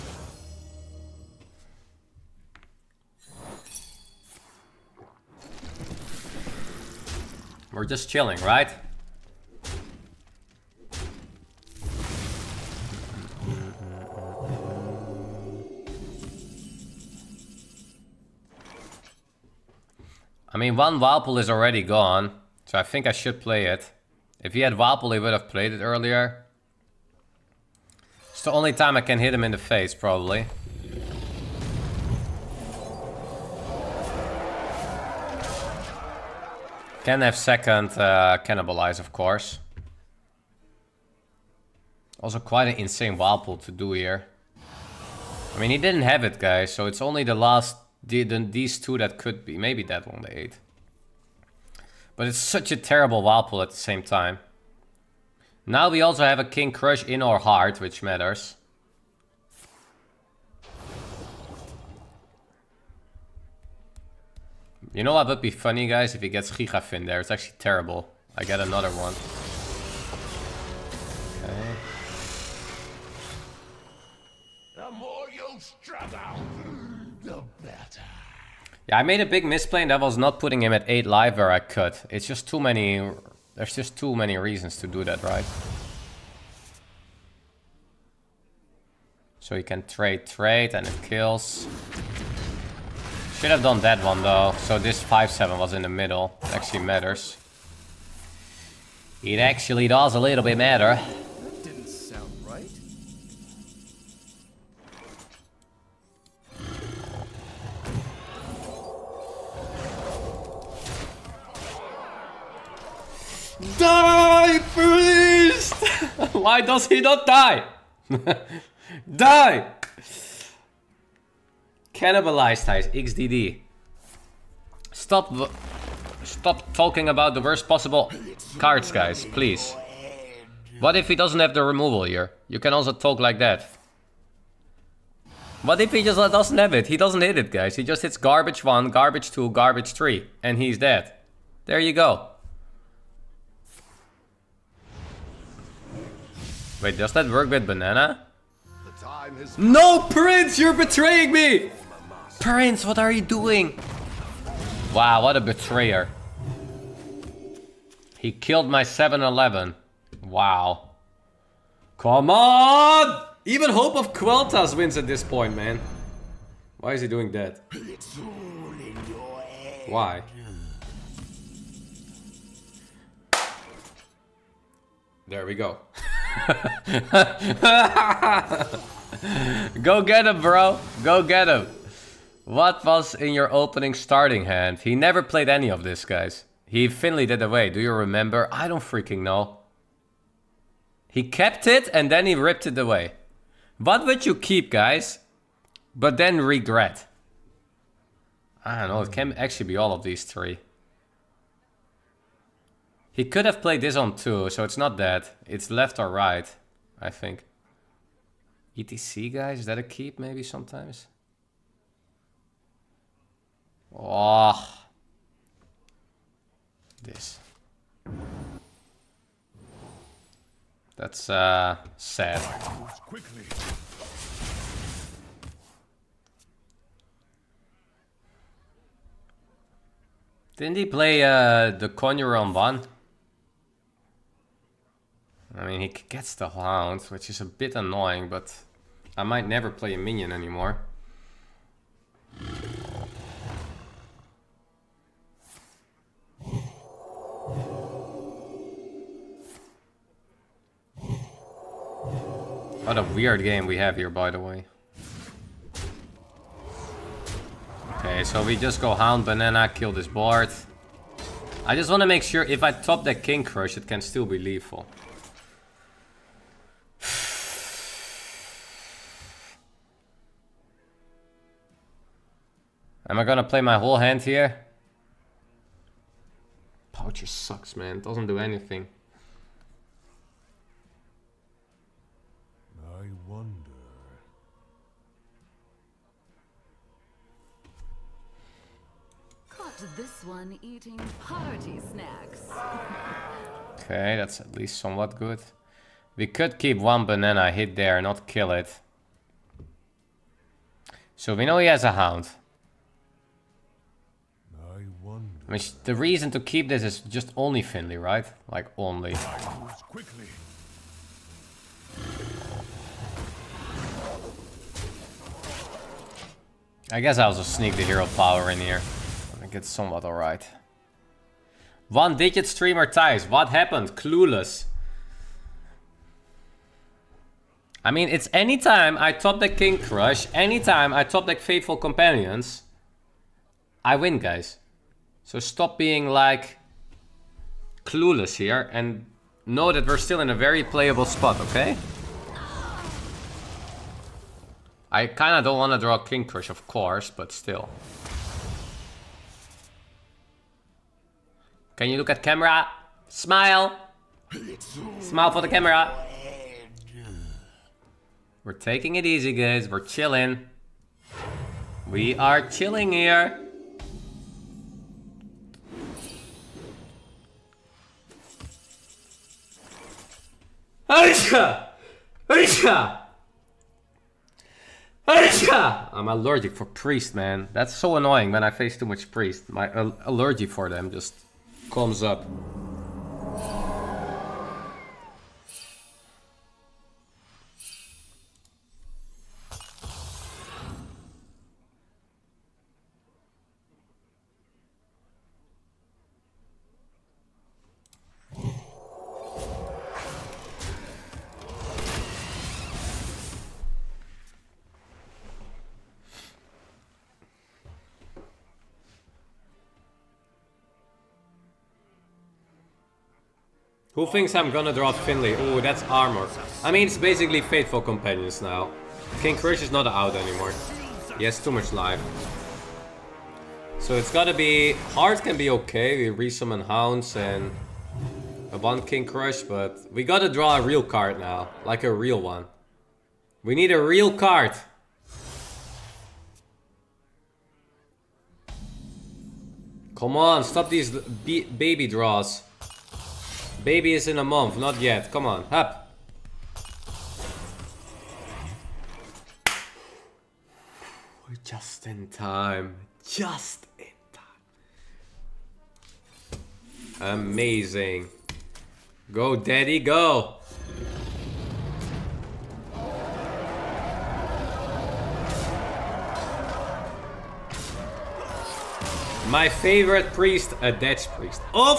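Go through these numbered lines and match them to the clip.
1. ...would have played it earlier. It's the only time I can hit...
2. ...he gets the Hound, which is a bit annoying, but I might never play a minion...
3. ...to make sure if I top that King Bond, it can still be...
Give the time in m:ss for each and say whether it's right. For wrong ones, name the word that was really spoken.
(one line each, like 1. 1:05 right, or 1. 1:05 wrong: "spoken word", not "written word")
1. 0:25 right
2. 3:55 right
3. 4:22 wrong: "Krush", not "Bond".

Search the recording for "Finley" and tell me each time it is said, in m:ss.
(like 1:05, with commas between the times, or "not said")
3:06, 5:07, 6:54.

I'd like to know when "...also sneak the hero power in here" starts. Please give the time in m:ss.
5:17.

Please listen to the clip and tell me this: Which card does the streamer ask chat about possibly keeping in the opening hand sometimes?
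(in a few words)
ETC.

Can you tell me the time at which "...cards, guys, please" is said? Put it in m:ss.
2:08.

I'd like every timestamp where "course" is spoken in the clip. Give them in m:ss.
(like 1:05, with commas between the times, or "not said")
0:39, 5:46.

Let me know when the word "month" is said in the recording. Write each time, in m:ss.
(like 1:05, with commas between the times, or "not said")
7:24.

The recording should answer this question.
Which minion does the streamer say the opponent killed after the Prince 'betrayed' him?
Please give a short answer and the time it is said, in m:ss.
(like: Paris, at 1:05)
7-Eleven, at 2:38.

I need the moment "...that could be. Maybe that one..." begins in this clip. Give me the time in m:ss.
0:48.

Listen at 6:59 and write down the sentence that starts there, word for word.
King Krush is not out anymore.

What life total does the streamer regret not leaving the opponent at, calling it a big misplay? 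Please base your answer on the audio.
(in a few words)
8.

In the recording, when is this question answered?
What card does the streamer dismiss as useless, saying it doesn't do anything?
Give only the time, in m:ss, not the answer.
4:36.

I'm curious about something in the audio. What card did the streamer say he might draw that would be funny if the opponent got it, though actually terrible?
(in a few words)
Gigafin.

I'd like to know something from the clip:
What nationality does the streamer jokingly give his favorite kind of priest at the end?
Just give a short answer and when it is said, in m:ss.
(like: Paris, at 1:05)
Dutch, at 7:50.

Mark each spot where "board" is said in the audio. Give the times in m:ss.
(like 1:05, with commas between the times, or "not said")
4:20.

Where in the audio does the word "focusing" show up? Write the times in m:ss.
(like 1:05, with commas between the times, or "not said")
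not said.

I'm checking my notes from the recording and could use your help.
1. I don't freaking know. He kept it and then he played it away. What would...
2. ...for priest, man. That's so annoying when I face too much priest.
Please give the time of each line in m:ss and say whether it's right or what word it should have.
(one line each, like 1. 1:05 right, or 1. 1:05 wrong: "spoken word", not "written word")
1. 3:08 wrong: "ripped", not "played"
2. 6:16 right.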